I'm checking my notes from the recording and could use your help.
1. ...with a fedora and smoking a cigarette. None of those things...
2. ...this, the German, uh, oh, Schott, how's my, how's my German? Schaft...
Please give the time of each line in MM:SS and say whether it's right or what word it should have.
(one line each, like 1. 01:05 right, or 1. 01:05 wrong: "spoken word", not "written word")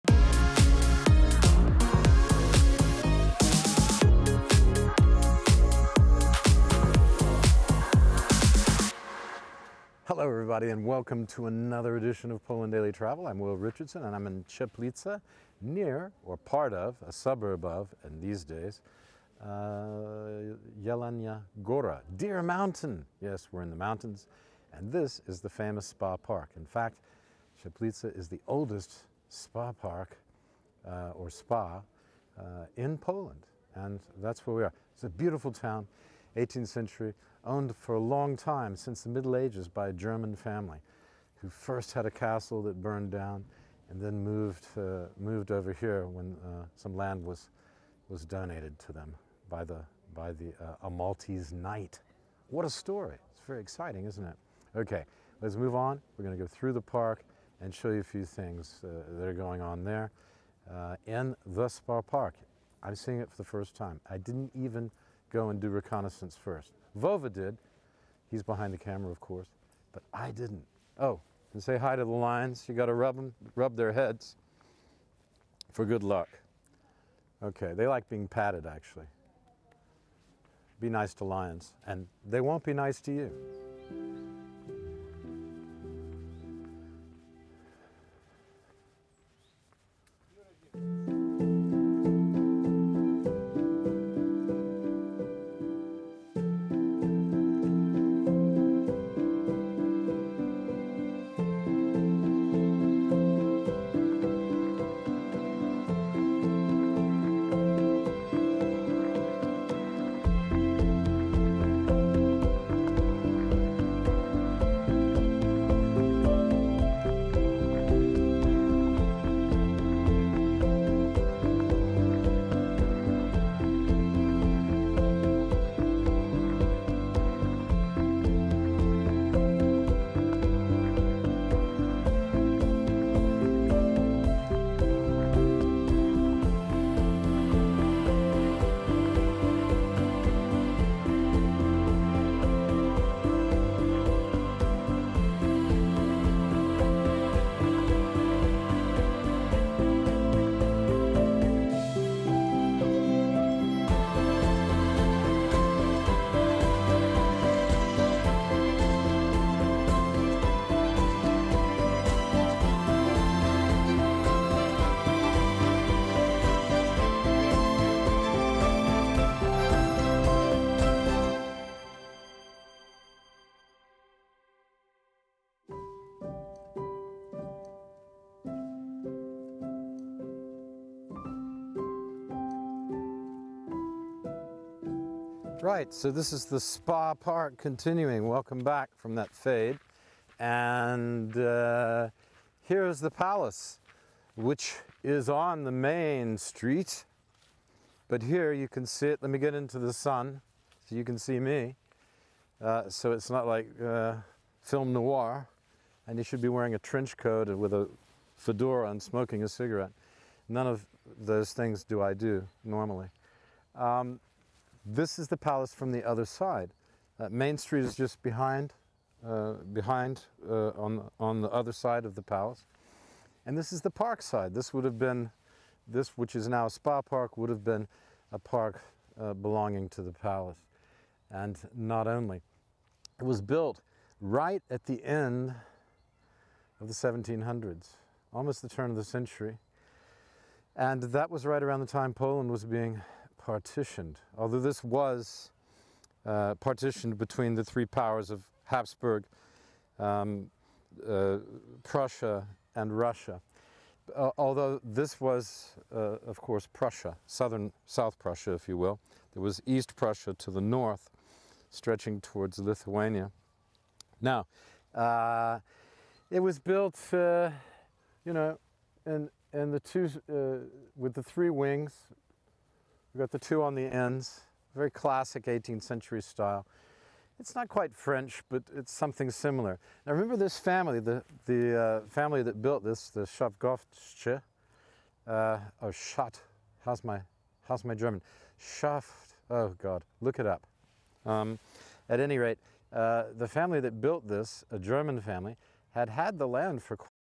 1. 03:27 right
2. 04:42 wrong: "Schafgottsche", not "German".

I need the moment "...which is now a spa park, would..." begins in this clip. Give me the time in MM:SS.
03:46.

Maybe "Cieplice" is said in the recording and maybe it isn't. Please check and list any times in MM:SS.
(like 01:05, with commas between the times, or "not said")
00:14, 00:27.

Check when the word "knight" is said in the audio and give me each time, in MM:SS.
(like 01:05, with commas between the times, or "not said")
00:51.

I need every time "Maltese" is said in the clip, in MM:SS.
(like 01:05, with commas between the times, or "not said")
00:50.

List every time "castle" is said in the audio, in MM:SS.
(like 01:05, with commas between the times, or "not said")
00:42.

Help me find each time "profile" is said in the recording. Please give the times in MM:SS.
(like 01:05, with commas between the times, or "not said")
not said.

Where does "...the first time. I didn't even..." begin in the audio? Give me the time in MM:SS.
01:03.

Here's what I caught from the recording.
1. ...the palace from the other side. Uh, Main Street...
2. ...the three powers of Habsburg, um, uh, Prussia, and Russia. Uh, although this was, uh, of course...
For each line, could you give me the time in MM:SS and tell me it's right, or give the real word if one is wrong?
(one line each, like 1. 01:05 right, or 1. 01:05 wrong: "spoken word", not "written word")
1. 03:35 right
2. 04:07 right.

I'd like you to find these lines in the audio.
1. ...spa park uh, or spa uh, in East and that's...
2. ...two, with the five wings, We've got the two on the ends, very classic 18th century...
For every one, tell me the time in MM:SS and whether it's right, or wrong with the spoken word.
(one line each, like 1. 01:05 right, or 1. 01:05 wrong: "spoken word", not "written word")
1. 00:29 wrong: "Poland", not "East"
2. 04:29 wrong: "three", not "five".